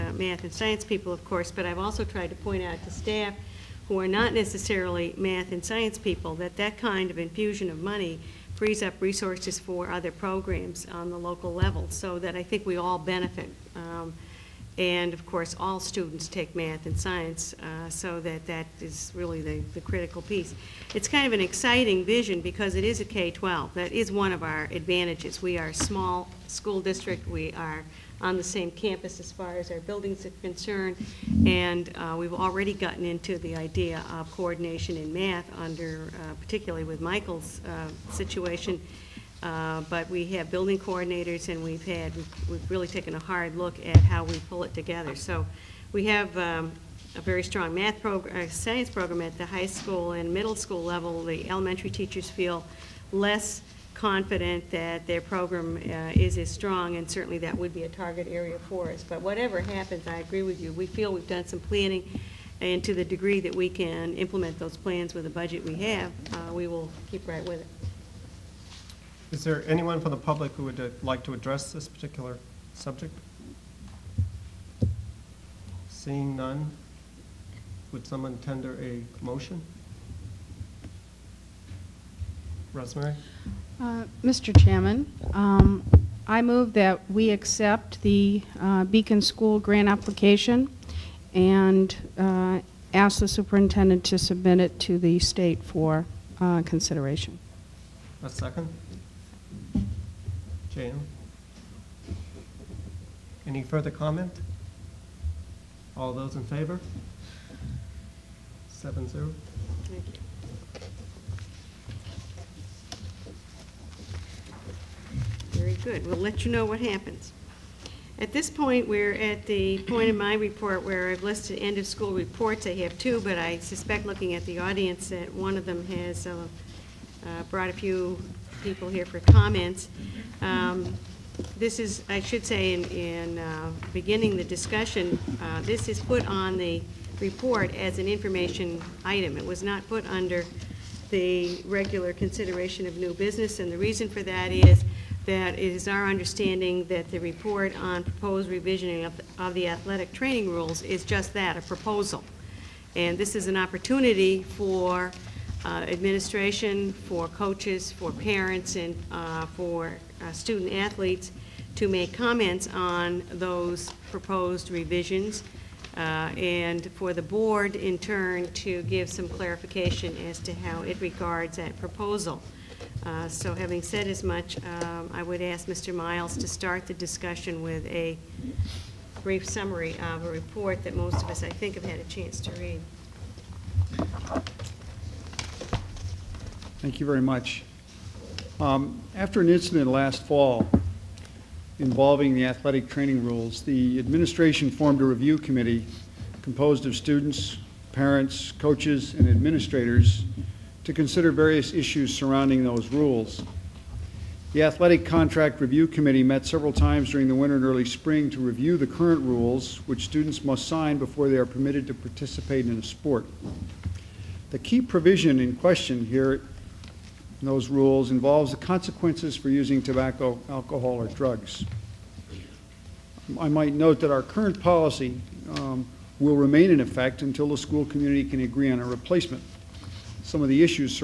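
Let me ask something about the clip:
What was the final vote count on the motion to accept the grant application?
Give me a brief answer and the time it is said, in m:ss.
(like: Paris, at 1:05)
7-0, at 1:48.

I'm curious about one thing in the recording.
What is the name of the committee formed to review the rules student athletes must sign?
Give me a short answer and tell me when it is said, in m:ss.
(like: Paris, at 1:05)
Athletic Contract Review Committee, at 3:24.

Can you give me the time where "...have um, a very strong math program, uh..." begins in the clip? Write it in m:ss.
0:46.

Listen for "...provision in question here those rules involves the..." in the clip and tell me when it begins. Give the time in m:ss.
3:34.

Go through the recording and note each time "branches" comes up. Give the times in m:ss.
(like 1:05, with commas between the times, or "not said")
not said.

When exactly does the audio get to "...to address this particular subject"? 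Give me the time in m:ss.
1:11.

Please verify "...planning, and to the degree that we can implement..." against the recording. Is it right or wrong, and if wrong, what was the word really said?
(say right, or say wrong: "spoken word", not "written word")
right.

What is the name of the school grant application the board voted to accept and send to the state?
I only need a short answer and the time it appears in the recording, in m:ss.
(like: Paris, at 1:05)
Beacon School, at 1:28.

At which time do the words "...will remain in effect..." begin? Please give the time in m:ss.
3:46.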